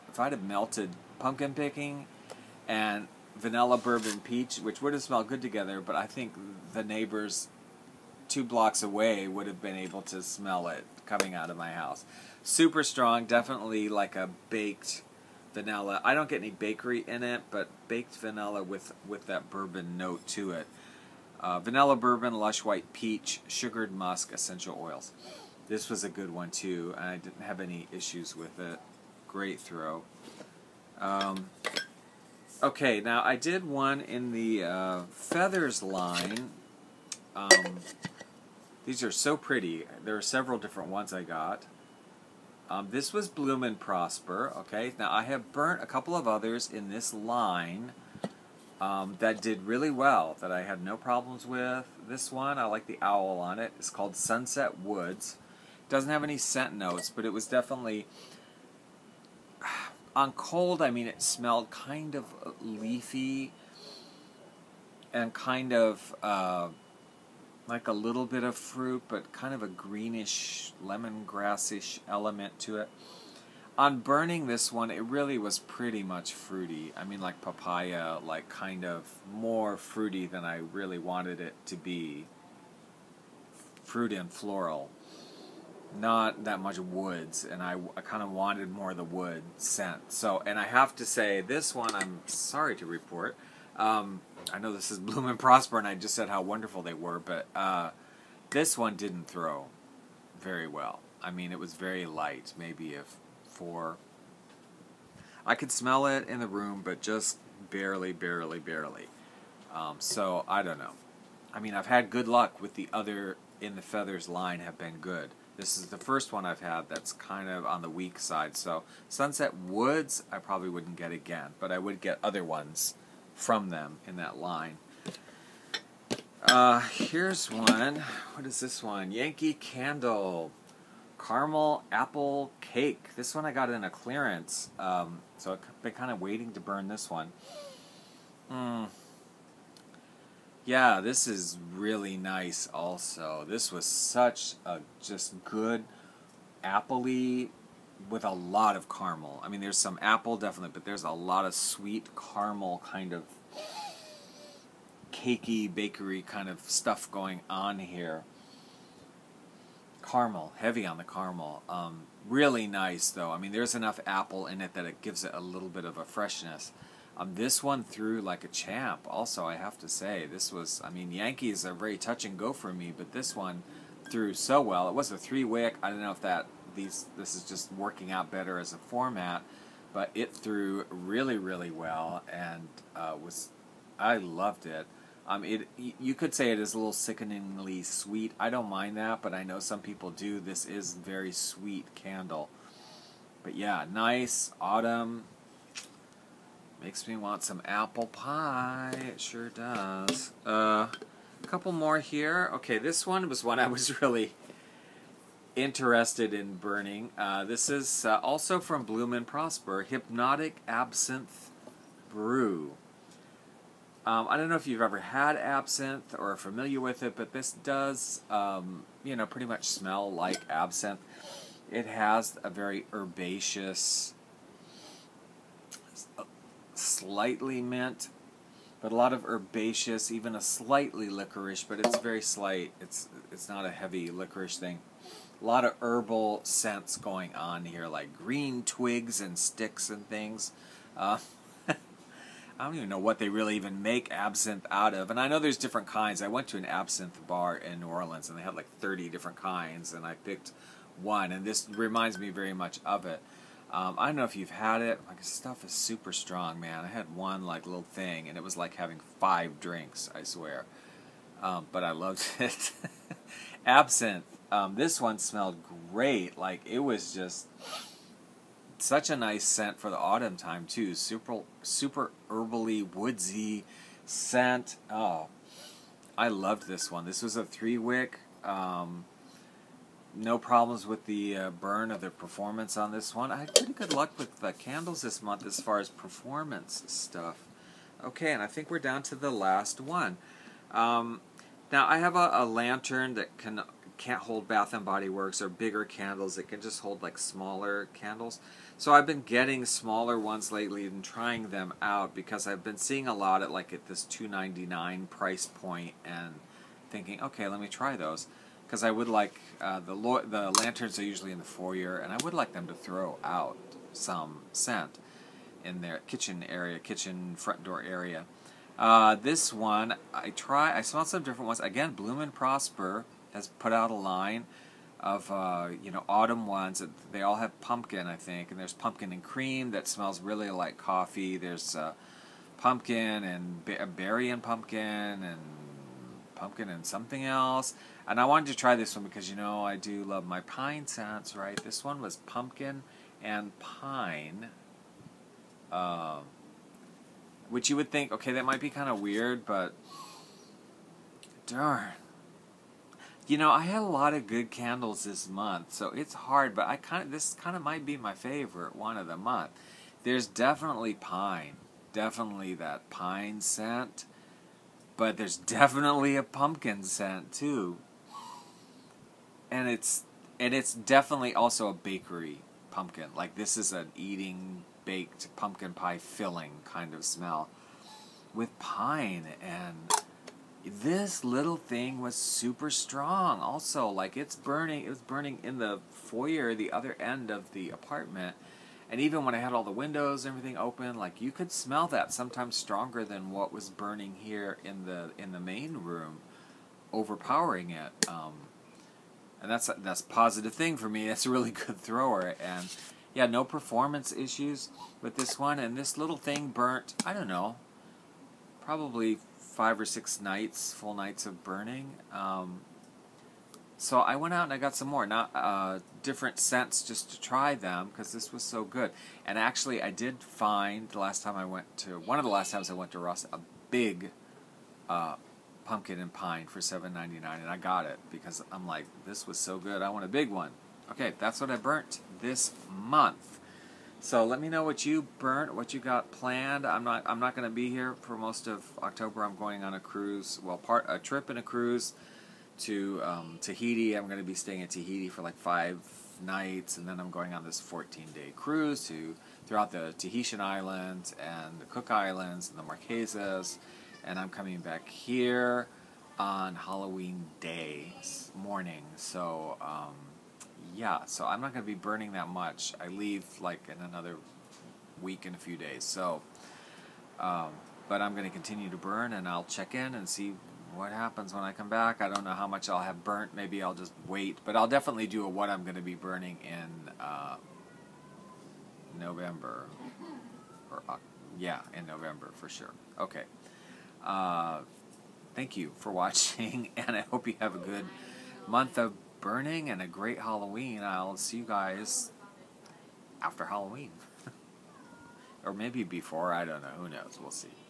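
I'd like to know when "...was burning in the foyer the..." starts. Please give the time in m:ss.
6:24.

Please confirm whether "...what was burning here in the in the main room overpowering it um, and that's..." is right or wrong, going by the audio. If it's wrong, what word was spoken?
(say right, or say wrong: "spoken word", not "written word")
right.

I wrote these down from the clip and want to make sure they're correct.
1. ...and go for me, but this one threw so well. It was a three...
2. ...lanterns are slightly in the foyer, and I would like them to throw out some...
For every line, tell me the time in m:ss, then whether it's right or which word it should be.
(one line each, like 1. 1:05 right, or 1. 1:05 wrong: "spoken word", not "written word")
1. 2:52 right
2. 5:10 wrong: "usually", not "slightly".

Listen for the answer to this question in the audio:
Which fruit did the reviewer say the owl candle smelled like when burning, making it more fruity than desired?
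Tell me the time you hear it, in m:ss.
1:17.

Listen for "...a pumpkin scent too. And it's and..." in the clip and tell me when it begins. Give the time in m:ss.
6:06.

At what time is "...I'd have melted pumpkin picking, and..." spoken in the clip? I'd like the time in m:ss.
0:00.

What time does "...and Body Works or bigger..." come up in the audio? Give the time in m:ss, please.
4:54.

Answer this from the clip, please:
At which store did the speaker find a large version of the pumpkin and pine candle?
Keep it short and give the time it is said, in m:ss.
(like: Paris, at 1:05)
Ross, at 7:02.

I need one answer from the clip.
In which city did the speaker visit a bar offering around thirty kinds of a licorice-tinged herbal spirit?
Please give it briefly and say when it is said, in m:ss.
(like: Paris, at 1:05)
New Orleans, at 4:07.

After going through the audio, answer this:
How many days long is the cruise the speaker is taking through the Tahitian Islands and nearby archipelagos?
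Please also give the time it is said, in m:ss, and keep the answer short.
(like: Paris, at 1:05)
14, at 7:27.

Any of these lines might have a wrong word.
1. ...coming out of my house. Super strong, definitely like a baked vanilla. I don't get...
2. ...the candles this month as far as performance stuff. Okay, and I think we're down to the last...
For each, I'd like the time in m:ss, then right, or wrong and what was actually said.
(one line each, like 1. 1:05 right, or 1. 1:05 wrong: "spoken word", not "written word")
1. 0:11 right
2. 4:44 right.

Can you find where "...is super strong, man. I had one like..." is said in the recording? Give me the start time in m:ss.
4:15.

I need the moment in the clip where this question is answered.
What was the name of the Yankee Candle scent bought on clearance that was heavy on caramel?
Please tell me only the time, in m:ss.
2:11.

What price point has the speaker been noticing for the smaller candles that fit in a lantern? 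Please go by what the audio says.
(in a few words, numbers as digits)
$2.99.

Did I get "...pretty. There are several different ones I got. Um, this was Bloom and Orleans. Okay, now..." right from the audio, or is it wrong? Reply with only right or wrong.
wrong.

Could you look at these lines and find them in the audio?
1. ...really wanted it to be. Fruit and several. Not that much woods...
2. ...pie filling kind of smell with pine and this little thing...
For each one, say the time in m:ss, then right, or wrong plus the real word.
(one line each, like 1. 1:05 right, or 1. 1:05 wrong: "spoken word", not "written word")
1. 1:20 wrong: "floral", not "several"
2. 6:15 right.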